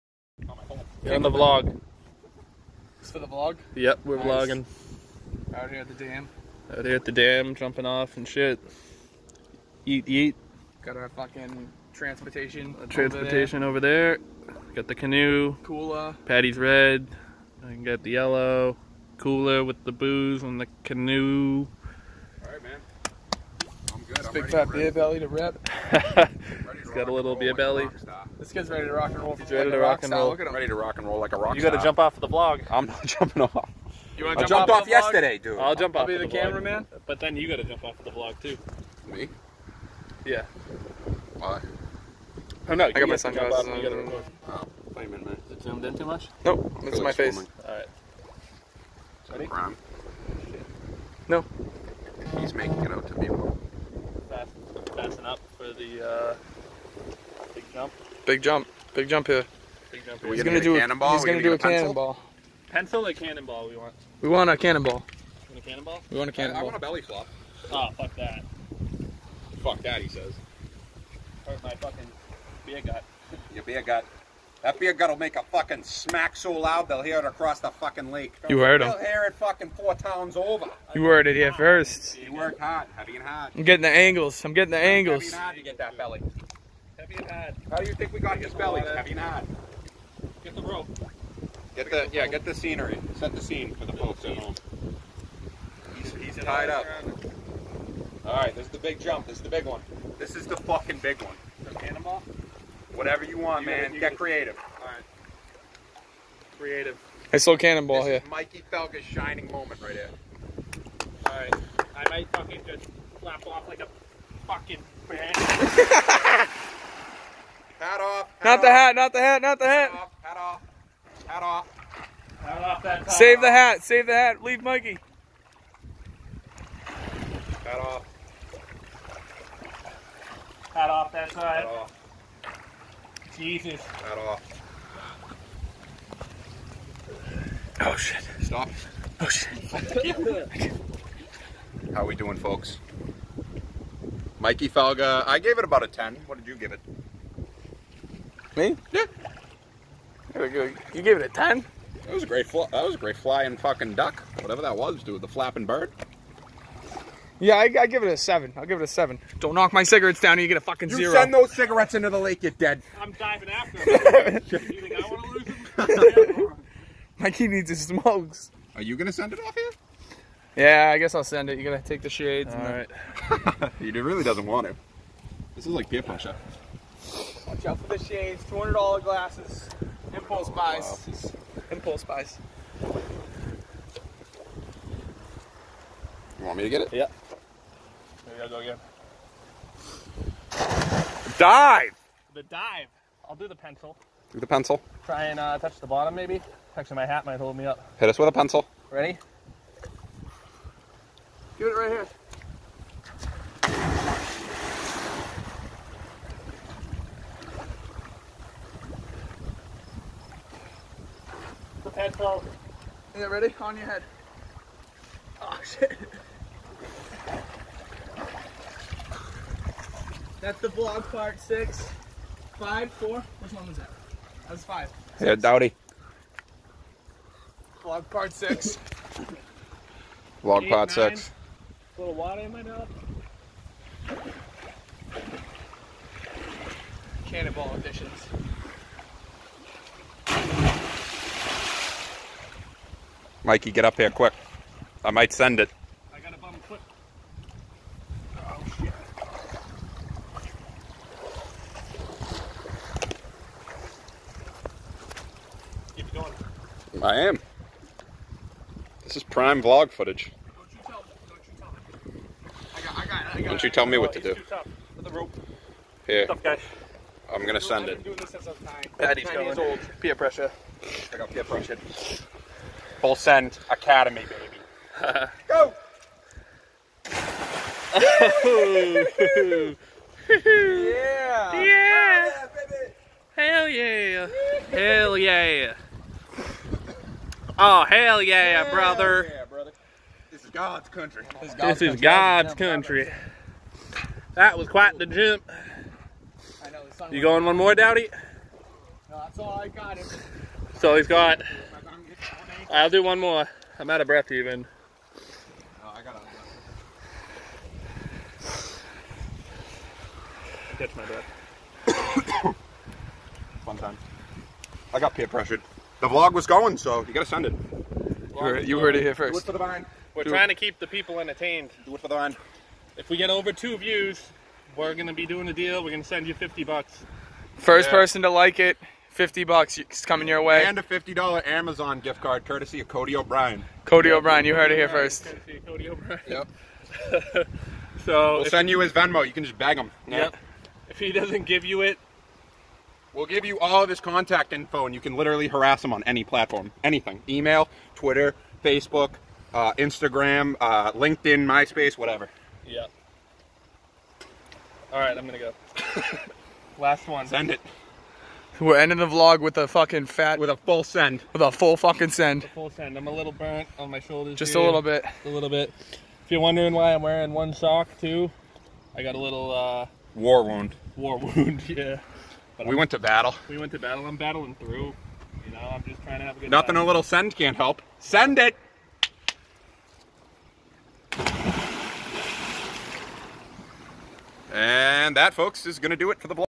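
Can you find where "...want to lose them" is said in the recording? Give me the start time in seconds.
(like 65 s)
165 s.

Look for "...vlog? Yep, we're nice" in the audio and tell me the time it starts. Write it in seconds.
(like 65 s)
3 s.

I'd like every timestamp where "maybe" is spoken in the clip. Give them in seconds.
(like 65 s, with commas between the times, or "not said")
188 s, 196 s.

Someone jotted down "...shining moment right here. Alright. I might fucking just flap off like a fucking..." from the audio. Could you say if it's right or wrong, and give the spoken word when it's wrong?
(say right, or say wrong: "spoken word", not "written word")
right.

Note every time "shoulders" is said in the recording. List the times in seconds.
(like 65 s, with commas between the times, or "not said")
363 s.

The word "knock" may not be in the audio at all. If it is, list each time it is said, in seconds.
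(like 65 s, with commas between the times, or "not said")
159 s.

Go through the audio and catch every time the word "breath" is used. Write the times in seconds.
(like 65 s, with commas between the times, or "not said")
304 s, 311 s.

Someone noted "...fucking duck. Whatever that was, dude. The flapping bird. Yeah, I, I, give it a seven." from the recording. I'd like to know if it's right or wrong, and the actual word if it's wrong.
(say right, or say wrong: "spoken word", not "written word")
right.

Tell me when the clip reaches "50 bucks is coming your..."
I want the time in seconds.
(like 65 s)
329 s.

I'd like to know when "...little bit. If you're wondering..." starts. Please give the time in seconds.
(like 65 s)
365 s.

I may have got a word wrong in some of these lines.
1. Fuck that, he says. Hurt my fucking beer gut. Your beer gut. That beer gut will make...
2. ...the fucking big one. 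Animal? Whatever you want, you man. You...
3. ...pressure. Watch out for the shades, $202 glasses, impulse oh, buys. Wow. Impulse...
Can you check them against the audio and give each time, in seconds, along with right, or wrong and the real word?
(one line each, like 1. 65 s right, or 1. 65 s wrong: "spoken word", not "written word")
1. 69 s right
2. 100 s right
3. 176 s wrong: "200", not "202".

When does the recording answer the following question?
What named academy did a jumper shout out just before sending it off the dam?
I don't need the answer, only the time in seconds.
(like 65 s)
273 s.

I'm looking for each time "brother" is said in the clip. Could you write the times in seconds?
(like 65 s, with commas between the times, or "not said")
288 s.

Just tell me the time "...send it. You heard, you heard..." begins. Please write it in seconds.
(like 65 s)
317 s.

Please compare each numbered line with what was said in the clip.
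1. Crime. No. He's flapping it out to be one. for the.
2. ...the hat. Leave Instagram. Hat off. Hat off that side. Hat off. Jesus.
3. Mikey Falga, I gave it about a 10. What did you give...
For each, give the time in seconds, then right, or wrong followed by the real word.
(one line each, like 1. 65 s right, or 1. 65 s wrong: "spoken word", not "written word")
1. 49 s wrong: "making", not "flapping"
2. 124 s wrong: "Mikey", not "Instagram"
3. 144 s right.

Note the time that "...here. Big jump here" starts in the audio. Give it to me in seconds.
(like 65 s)
59 s.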